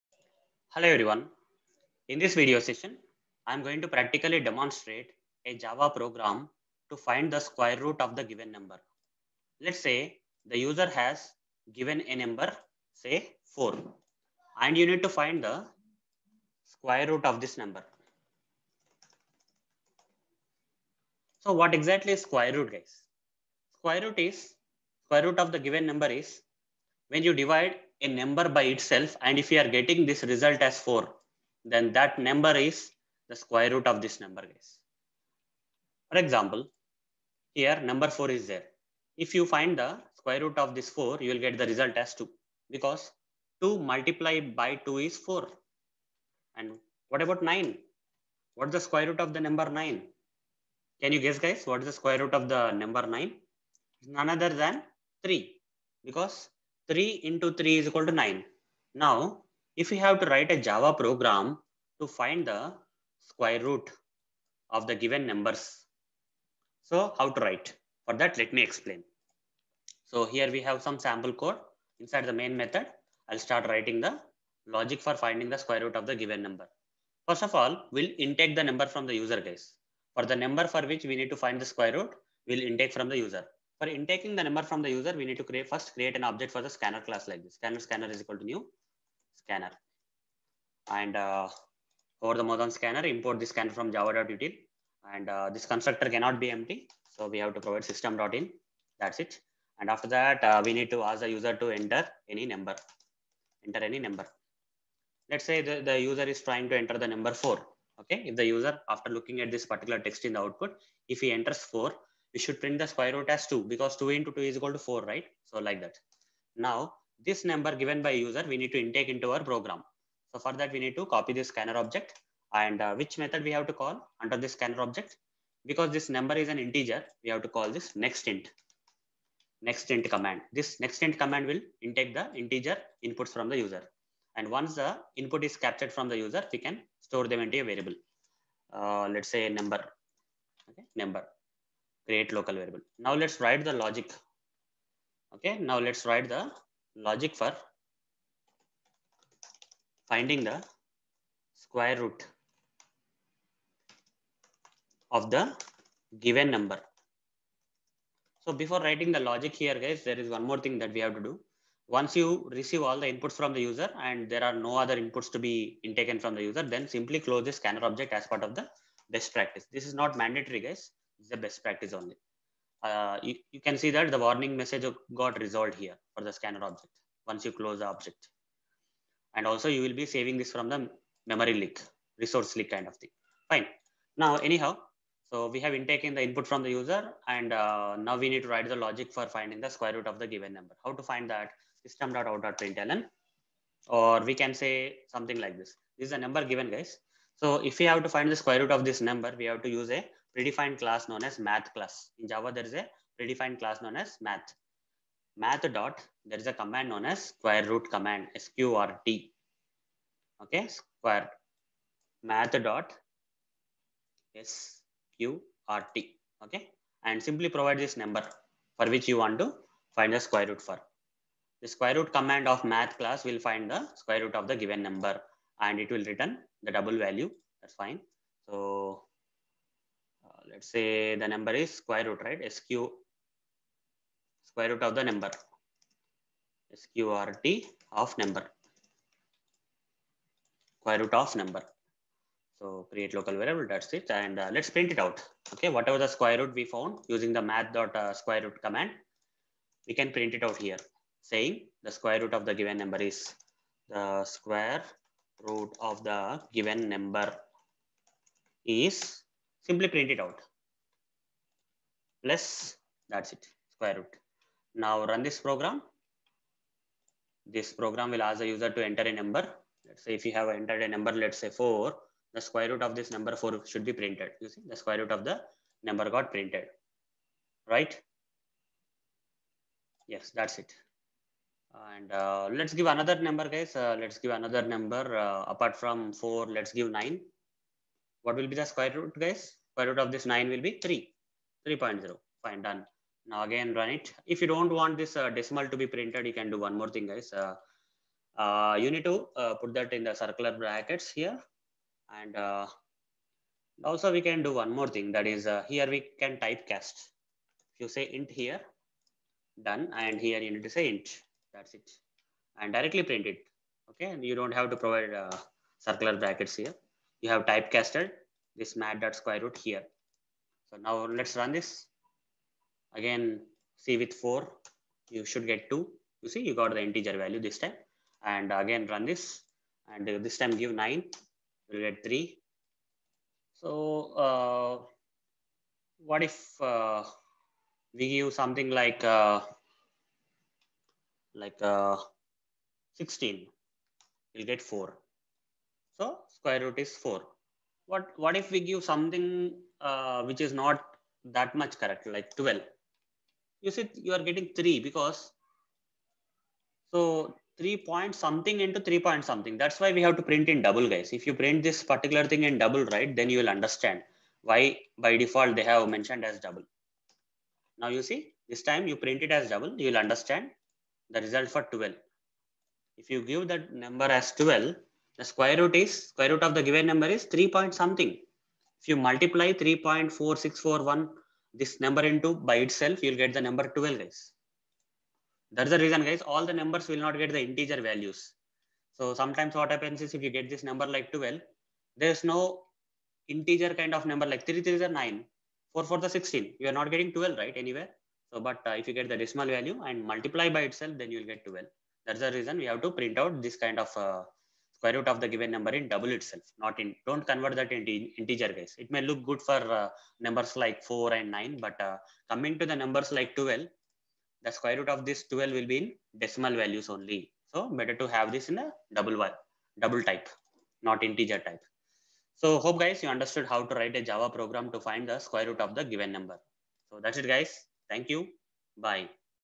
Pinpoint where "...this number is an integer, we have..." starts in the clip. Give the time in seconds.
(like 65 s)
125 s.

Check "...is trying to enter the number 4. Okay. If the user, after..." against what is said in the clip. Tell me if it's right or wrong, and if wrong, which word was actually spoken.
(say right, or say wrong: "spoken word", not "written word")
right.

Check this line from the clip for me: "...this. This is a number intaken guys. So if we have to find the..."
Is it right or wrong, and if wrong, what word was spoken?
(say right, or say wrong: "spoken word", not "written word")
wrong: "given", not "intaken".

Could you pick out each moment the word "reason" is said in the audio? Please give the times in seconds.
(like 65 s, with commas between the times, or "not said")
385 s, 402 s.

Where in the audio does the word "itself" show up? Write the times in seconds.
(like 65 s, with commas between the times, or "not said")
28 s, 382 s, 400 s, 406 s.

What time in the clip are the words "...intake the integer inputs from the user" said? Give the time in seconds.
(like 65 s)
131 s.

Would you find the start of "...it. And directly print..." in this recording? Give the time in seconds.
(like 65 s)
311 s.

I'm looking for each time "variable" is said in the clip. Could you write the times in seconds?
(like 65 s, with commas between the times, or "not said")
137 s, 142 s, 243 s.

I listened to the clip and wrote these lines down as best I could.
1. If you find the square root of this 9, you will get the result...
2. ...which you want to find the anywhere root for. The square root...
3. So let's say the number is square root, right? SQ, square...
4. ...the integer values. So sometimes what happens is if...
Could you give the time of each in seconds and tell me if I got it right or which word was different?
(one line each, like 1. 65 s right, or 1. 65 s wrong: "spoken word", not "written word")
1. 39 s wrong: "4", not "9"
2. 218 s wrong: "square", not "anywhere"
3. 228 s right
4. 387 s right.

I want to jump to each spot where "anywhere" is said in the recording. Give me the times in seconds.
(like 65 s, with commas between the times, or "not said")
397 s.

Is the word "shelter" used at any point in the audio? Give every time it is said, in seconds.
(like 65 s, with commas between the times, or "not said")
not said.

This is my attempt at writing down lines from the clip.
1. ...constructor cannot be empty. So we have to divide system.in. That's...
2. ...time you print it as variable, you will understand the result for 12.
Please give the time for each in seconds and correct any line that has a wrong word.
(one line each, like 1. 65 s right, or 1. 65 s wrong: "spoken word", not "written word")
1. 95 s wrong: "provide", not "divide"
2. 368 s wrong: "double", not "variable".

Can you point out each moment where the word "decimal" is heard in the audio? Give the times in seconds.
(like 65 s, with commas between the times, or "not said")
295 s, 399 s, 416 s.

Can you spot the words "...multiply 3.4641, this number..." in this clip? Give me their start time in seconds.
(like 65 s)
378 s.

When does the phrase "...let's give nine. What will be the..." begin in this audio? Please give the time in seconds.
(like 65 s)
286 s.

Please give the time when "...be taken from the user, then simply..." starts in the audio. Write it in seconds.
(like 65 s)
165 s.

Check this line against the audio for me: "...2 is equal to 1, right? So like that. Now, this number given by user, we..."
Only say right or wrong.
wrong.